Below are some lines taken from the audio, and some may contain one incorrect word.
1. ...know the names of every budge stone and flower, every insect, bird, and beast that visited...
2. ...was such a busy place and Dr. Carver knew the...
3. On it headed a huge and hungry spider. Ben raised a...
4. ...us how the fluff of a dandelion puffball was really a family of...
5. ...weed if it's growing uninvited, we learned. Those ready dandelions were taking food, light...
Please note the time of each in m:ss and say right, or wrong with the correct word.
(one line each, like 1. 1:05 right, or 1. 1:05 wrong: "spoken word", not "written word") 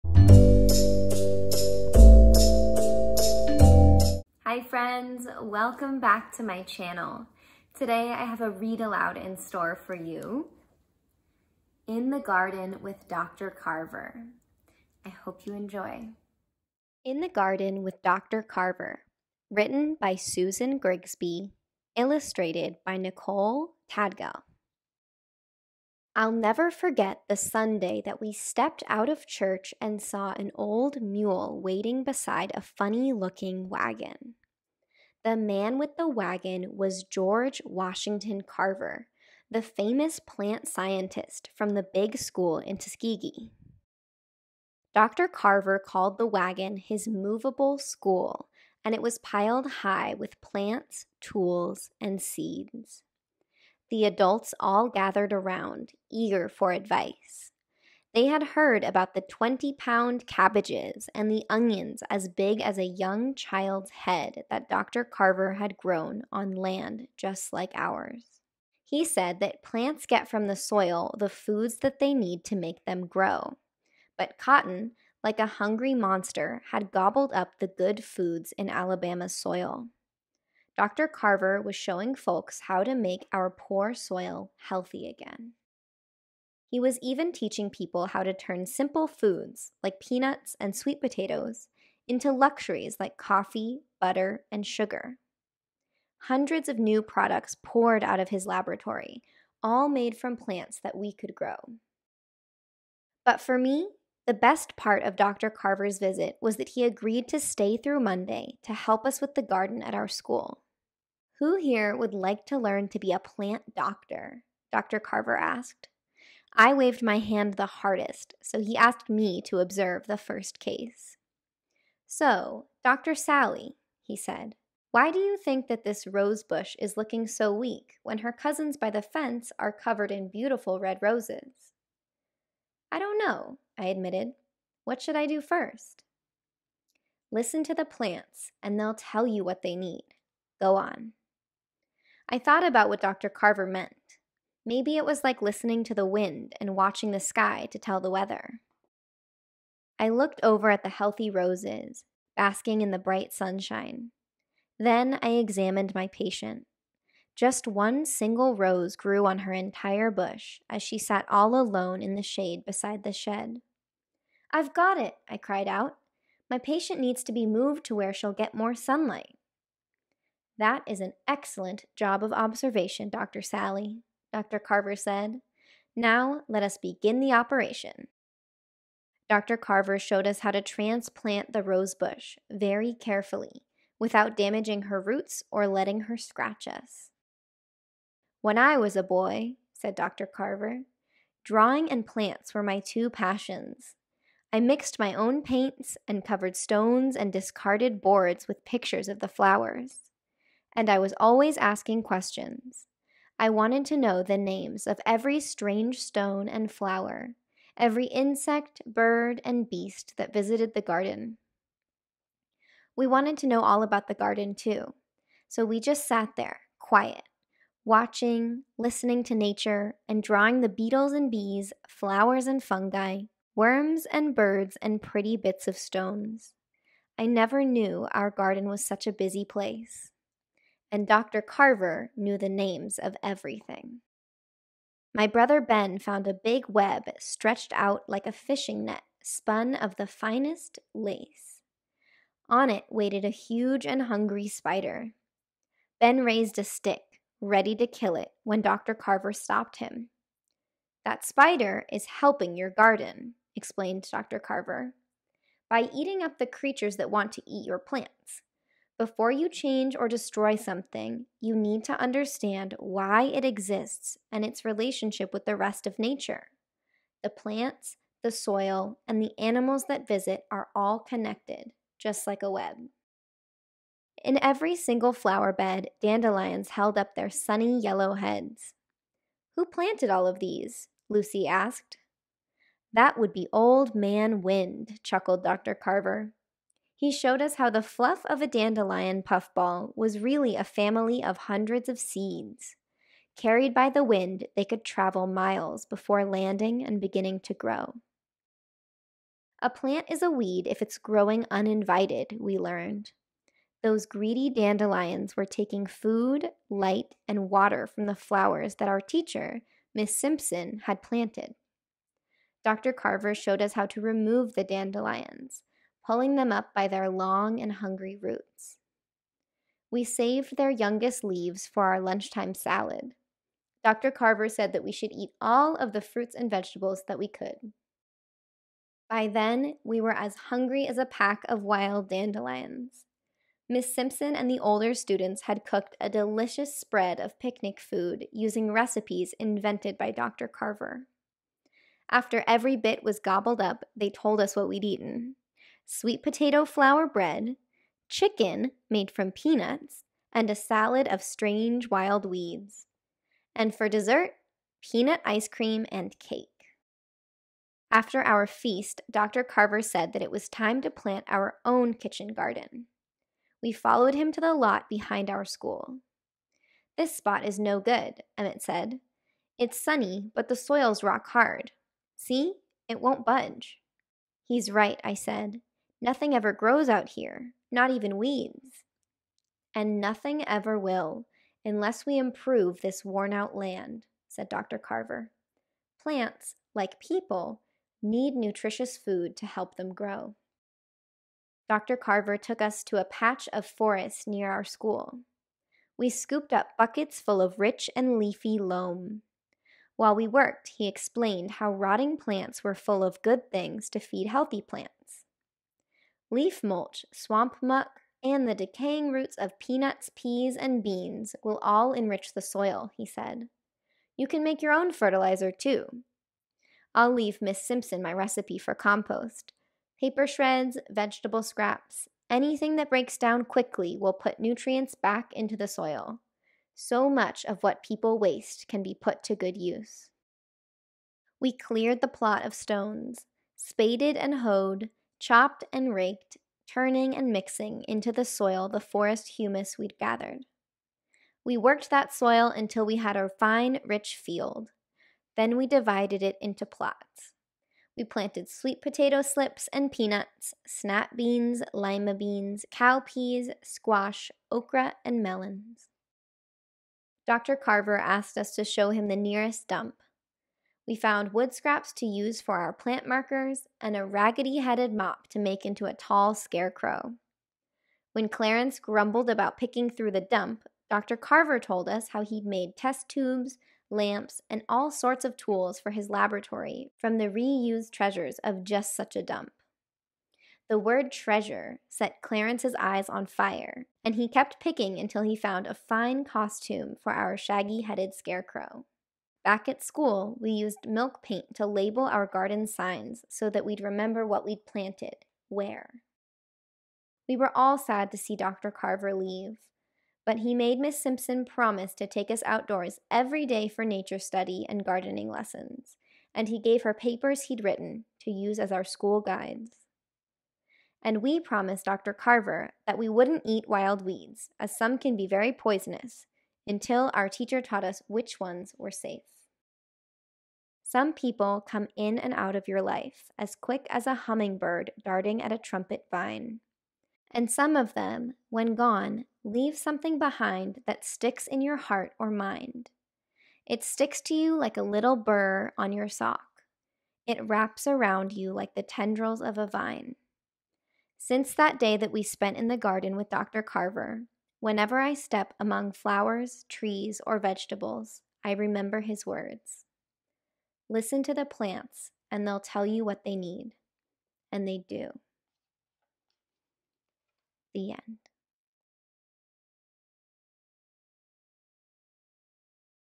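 1. 3:23 wrong: "strange", not "budge"
2. 3:48 right
3. 4:02 wrong: "waited", not "headed"
4. 4:47 right
5. 5:00 wrong: "greedy", not "ready".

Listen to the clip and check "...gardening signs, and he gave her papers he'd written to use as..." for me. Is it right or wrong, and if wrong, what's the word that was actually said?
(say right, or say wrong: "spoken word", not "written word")
wrong: "lessons", not "signs".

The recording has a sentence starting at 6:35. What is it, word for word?
We scooped up buckets full of rich and leafy loam.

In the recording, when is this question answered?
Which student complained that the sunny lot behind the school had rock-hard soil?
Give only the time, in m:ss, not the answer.
6:08.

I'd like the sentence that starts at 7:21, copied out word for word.
We worked that soil until we had a fine, rich field.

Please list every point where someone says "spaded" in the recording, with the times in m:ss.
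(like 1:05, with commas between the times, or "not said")
7:13.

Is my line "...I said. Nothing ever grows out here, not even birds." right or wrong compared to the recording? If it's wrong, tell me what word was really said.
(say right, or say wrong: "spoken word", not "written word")
wrong: "weeds", not "birds".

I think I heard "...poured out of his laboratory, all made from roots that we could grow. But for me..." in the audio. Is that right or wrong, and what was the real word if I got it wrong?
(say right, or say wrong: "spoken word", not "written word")
wrong: "plants", not "roots".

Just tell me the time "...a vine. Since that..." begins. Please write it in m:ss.
8:59.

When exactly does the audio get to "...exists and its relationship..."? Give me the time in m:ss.
4:23.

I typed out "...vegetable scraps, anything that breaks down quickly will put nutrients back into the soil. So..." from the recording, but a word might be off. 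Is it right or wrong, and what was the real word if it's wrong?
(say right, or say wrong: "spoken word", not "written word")
right.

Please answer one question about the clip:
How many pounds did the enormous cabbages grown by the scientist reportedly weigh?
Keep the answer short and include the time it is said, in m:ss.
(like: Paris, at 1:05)
20, at 0:59.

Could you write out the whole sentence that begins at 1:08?
He said that plants get from the soil the foods that they need to make them grow.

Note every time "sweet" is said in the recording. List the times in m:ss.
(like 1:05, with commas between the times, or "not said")
1:30, 5:45, 7:28.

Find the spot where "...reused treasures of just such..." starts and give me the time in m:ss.
7:57.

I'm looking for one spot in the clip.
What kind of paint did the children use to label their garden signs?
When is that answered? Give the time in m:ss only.
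8:10.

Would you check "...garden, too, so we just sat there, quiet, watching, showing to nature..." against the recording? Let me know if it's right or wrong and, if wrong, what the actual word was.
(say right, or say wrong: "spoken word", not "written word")
wrong: "listening", not "showing".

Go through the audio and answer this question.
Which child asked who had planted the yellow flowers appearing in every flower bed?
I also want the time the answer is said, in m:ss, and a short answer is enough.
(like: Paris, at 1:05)
Lucy, at 4:41.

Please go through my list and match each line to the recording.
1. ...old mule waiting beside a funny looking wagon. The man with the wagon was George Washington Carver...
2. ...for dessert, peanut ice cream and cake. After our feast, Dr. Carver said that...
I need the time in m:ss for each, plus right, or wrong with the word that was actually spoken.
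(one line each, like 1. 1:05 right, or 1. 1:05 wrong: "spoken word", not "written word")
1. 0:30 right
2. 5:53 right.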